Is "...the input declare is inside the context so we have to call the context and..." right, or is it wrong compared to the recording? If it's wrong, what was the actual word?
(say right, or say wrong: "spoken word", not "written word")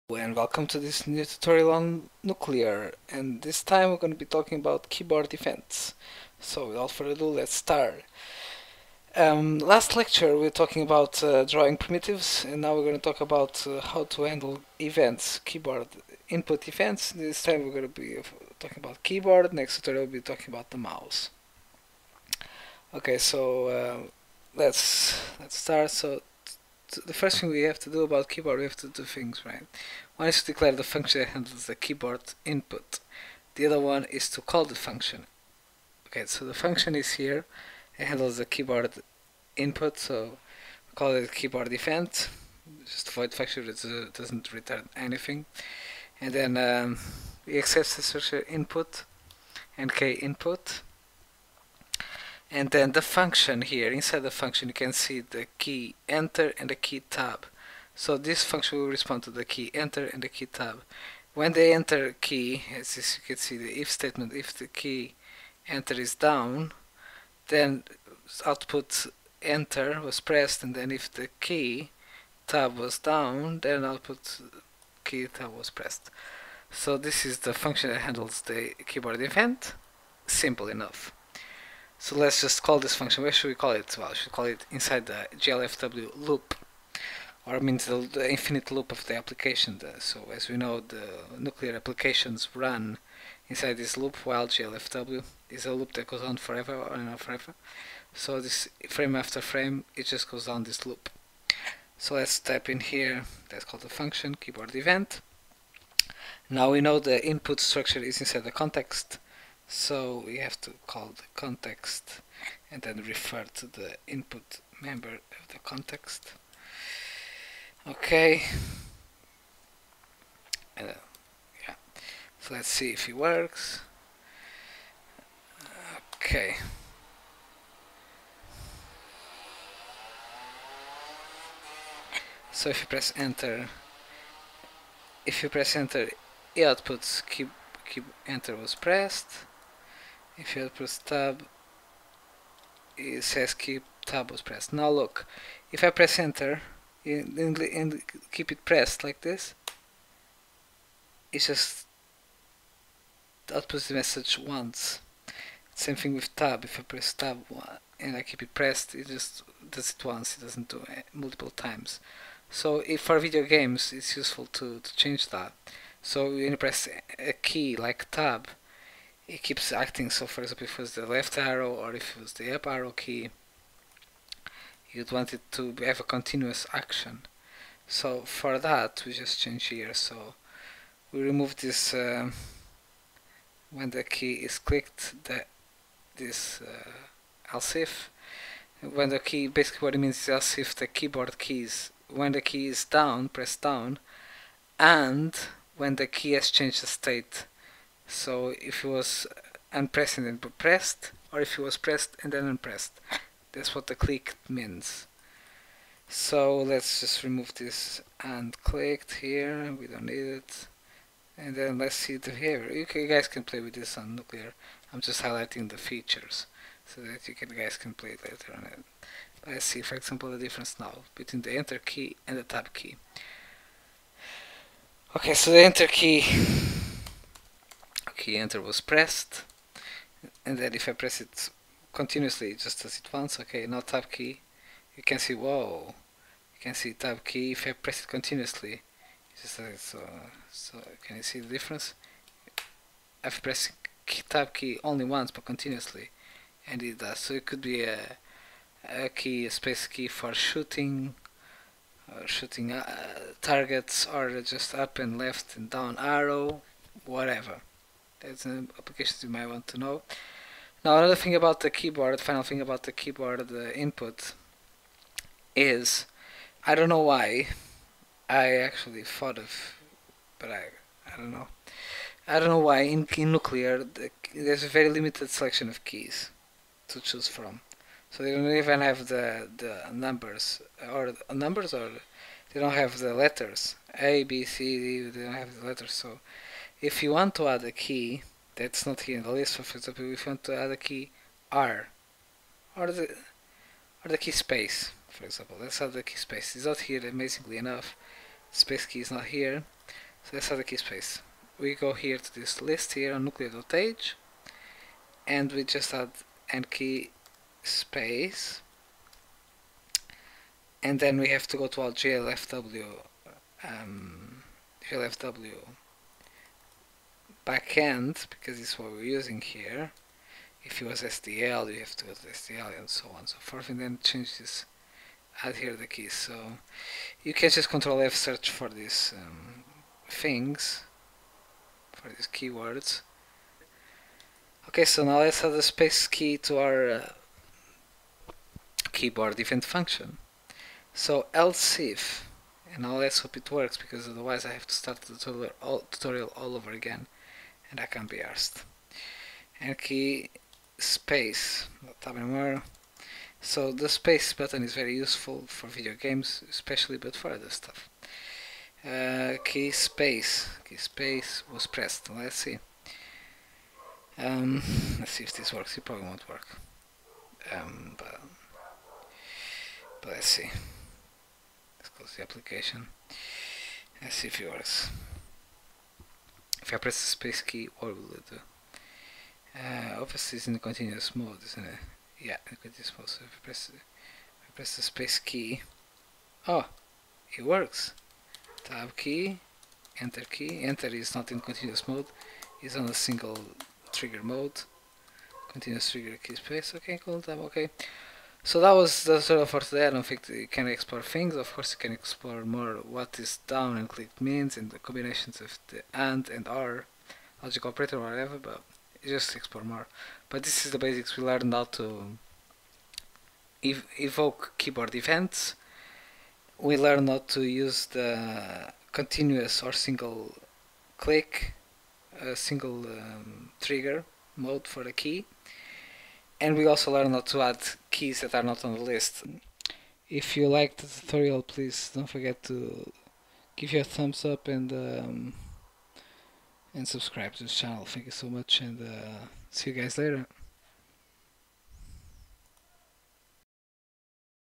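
wrong: "structure", not "declare".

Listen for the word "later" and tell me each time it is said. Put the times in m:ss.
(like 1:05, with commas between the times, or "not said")
3:38, 7:19.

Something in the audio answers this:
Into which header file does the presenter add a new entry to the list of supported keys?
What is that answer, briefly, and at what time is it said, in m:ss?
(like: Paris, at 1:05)
nuklear.h, at 5:03.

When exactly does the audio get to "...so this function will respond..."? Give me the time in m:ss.
0:57.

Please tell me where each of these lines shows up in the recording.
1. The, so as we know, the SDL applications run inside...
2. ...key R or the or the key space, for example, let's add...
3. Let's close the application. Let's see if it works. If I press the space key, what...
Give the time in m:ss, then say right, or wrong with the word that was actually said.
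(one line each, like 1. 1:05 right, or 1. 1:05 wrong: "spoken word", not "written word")
1. 1:29 wrong: "Nuklear", not "SDL"
2. 4:50 right
3. 6:11 right.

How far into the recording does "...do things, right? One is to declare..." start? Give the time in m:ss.
0:28.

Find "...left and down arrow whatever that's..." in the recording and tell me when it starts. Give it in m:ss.
4:15.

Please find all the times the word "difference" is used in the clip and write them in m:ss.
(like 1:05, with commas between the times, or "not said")
3:40, 4:01.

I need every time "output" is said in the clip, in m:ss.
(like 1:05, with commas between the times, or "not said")
1:08, 1:13, 2:16, 2:33.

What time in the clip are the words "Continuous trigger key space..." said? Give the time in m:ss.
6:35.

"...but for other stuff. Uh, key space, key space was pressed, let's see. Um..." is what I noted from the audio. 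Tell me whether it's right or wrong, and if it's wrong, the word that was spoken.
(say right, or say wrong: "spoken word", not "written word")
right.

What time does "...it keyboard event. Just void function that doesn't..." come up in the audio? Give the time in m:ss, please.
0:41.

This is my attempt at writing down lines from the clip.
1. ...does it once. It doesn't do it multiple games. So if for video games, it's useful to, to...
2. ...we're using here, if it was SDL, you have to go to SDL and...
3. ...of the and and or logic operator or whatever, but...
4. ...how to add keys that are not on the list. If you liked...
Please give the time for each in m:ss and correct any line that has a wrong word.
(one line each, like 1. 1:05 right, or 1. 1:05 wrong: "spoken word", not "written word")
1. 2:39 wrong: "times", not "games"
2. 5:18 right
3. 6:45 right
4. 7:07 right.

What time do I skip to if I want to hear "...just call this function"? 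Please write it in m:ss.
1:22.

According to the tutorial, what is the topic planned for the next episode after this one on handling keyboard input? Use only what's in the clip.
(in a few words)
The mouse.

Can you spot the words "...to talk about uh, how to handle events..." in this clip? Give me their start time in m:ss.
0:12.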